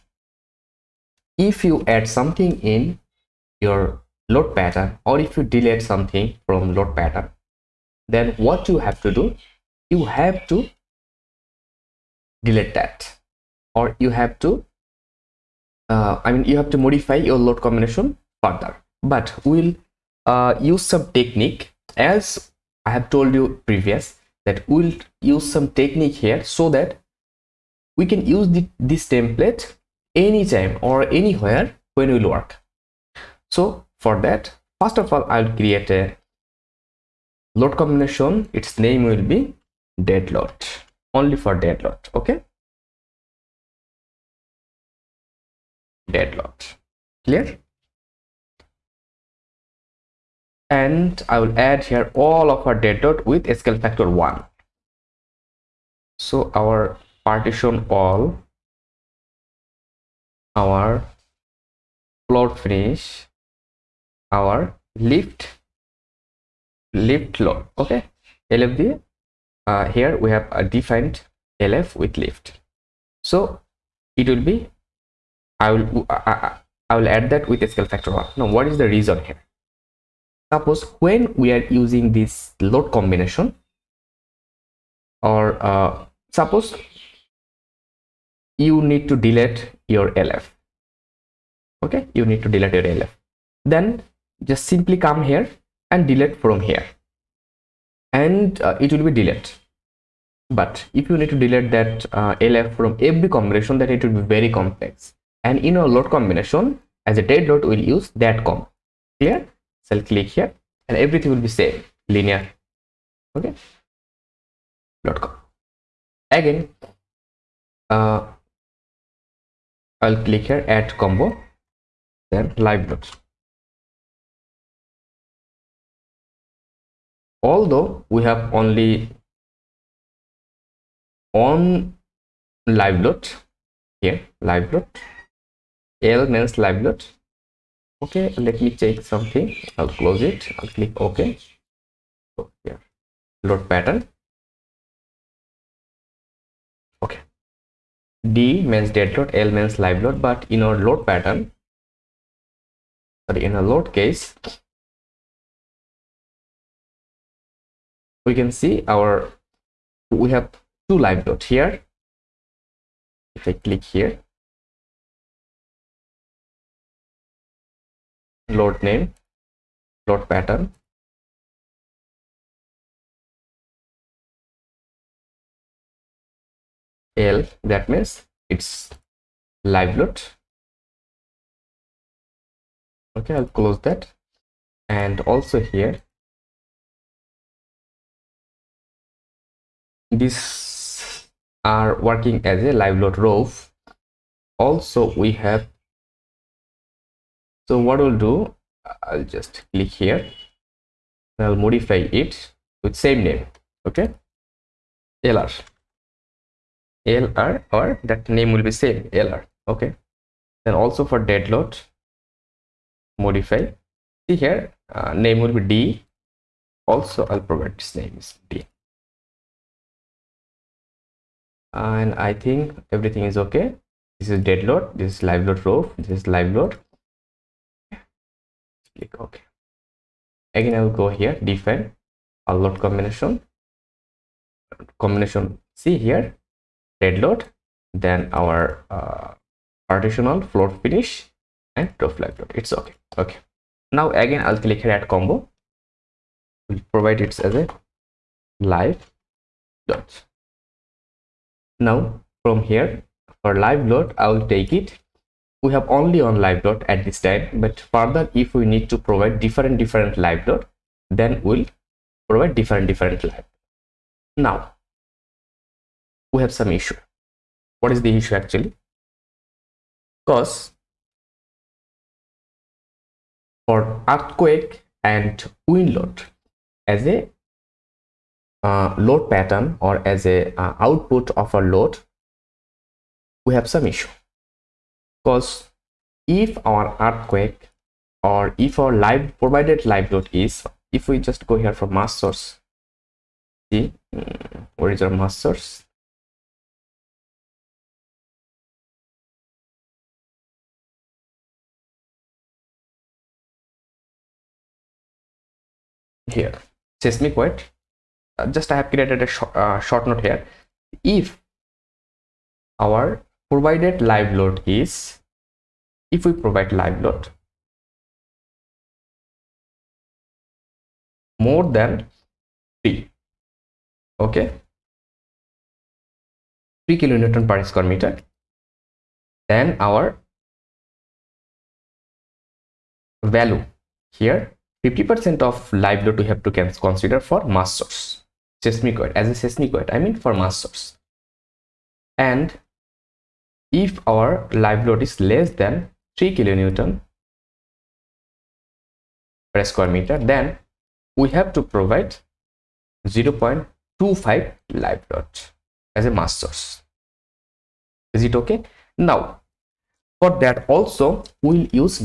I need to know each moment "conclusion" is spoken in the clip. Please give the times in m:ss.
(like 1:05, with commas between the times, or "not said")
not said.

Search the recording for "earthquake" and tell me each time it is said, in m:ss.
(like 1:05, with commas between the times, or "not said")
4:34, 4:47.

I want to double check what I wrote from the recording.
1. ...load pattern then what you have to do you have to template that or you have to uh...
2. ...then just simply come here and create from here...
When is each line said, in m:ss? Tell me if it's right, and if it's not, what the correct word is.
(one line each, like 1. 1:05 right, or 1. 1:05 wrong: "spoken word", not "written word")
1. 0:06 wrong: "delete", not "template"
2. 1:33 wrong: "delete", not "create".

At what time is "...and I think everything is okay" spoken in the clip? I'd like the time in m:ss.
3:41.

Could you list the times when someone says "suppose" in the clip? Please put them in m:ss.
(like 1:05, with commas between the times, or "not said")
1:20, 1:26.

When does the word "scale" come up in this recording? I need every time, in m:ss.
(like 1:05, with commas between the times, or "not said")
0:53, 1:17.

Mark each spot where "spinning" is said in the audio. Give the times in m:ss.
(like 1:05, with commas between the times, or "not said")
not said.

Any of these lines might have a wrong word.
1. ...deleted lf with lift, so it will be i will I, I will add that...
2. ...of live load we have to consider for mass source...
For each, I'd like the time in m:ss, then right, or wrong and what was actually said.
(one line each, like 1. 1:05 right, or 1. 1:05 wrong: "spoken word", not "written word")
1. 1:10 wrong: "defined", not "deleted"
2. 5:35 right.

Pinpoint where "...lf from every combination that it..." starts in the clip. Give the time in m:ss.
1:42.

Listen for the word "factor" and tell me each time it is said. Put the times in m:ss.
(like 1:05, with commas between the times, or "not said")
0:53, 1:17.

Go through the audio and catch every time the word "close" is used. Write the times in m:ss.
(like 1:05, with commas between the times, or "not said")
2:20, 3:03.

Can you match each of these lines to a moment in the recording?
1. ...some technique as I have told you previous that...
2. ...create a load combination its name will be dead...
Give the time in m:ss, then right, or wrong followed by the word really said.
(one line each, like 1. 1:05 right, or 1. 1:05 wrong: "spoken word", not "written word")
1. 0:20 right
2. 0:35 right.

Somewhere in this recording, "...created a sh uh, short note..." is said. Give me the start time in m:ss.
5:08.